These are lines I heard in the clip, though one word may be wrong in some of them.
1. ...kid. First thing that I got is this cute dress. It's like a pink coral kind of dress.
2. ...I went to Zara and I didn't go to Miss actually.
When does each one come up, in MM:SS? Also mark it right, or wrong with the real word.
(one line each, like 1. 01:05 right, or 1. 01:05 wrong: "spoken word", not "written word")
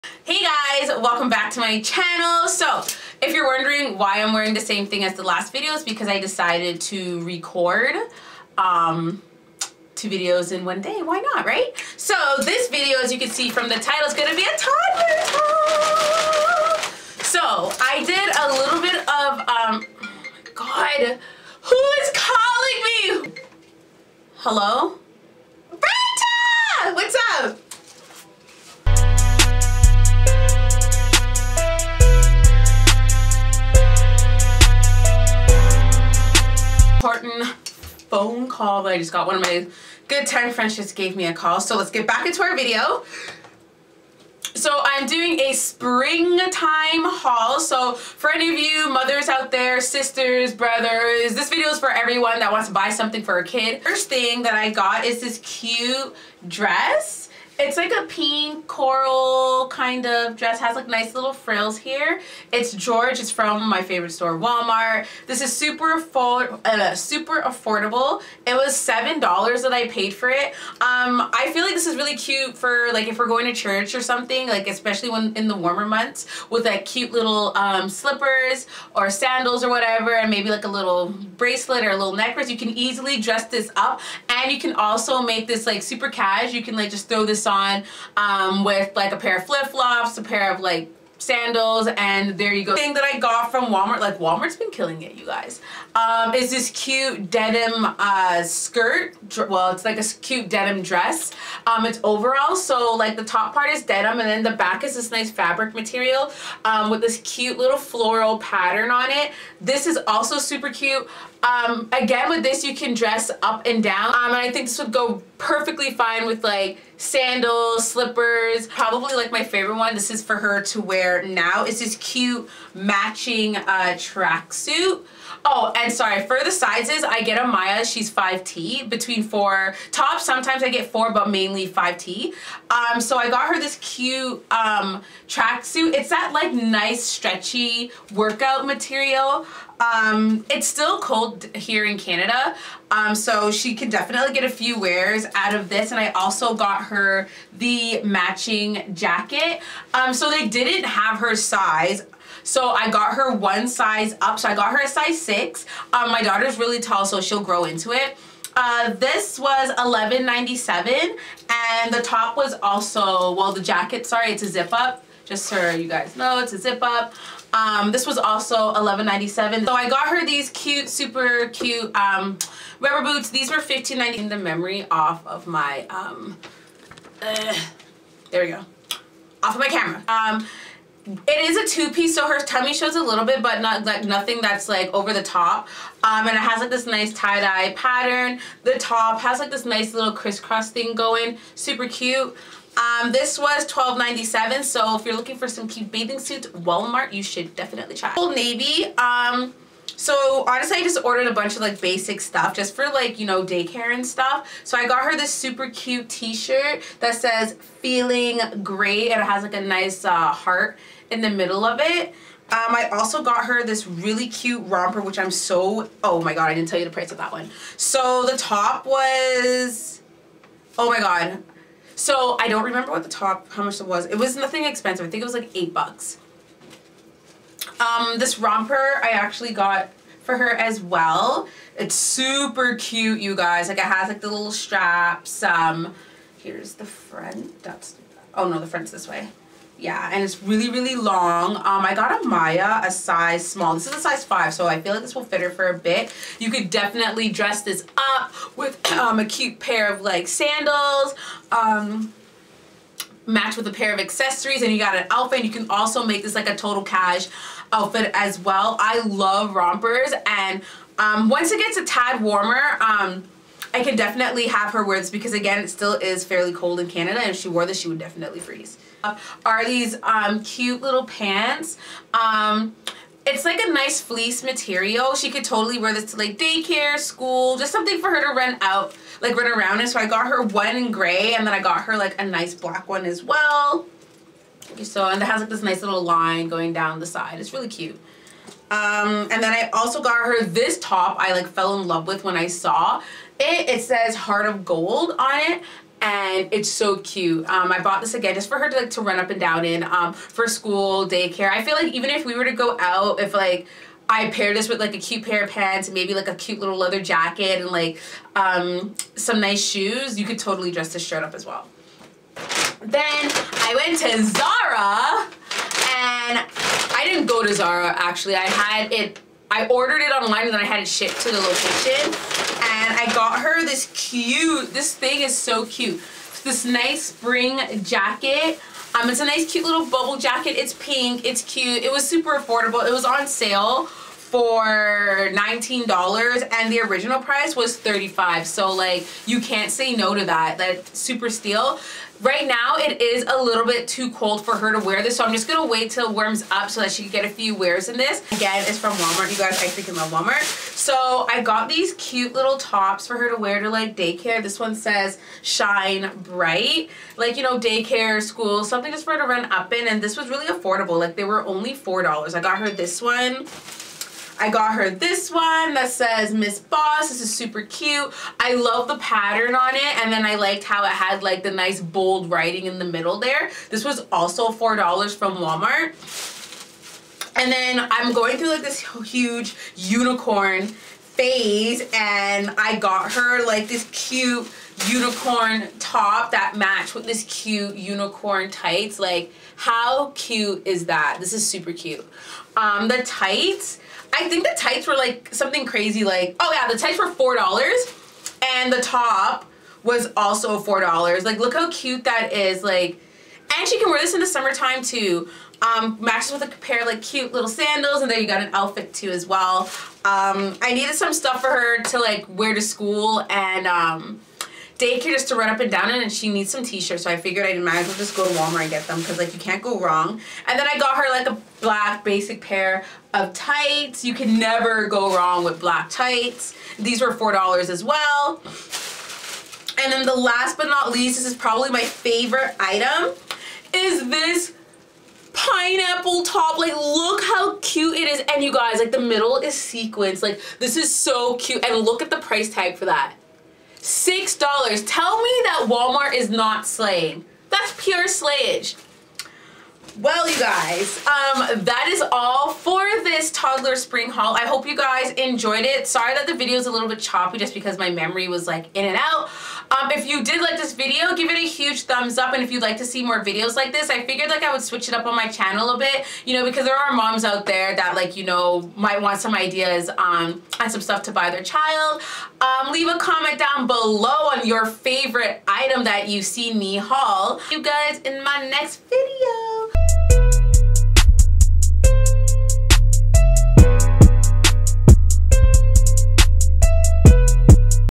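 1. 00:53 right
2. 05:13 wrong: "Zara", not "Miss".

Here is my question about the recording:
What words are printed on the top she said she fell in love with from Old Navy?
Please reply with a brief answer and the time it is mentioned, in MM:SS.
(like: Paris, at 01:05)
Heart of Gold, at 04:54.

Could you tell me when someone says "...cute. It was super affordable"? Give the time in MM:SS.
05:31.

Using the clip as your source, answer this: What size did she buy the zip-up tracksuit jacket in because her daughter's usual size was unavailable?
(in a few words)
6.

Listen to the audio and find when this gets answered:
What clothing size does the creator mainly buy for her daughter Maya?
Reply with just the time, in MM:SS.
02:11.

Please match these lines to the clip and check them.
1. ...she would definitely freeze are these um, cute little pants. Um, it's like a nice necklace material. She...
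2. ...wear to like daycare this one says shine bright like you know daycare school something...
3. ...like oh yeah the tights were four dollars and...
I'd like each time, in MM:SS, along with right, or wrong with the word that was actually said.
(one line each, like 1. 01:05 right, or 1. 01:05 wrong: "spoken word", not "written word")
1. 04:27 wrong: "fleece", not "necklace"
2. 05:53 right
3. 06:36 right.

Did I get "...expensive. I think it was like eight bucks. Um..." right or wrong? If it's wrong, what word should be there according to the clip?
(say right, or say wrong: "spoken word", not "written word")
right.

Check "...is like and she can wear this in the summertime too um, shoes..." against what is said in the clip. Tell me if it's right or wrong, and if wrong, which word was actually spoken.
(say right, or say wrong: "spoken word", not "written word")
wrong: "matches", not "shoes".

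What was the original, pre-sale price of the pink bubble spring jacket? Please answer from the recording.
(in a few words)
$35.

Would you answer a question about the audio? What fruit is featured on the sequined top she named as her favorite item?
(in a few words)
Pineapple.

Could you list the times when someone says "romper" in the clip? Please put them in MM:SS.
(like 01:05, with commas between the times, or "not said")
03:34, 03:48, 04:19.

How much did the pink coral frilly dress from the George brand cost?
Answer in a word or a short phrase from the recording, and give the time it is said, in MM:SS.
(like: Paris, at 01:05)
$7, at 01:08.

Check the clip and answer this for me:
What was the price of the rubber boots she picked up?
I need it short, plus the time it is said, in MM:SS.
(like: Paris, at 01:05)
$15.90, at 02:53.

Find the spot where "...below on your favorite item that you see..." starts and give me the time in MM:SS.
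07:53.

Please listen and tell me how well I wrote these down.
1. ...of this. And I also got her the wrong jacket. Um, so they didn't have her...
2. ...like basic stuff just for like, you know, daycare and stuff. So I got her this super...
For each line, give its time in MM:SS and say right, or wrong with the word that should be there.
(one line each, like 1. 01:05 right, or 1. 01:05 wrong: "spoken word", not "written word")
1. 02:25 wrong: "matching", not "wrong"
2. 03:21 right.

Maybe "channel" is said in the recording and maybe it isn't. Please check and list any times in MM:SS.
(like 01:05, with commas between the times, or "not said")
00:01, 07:45.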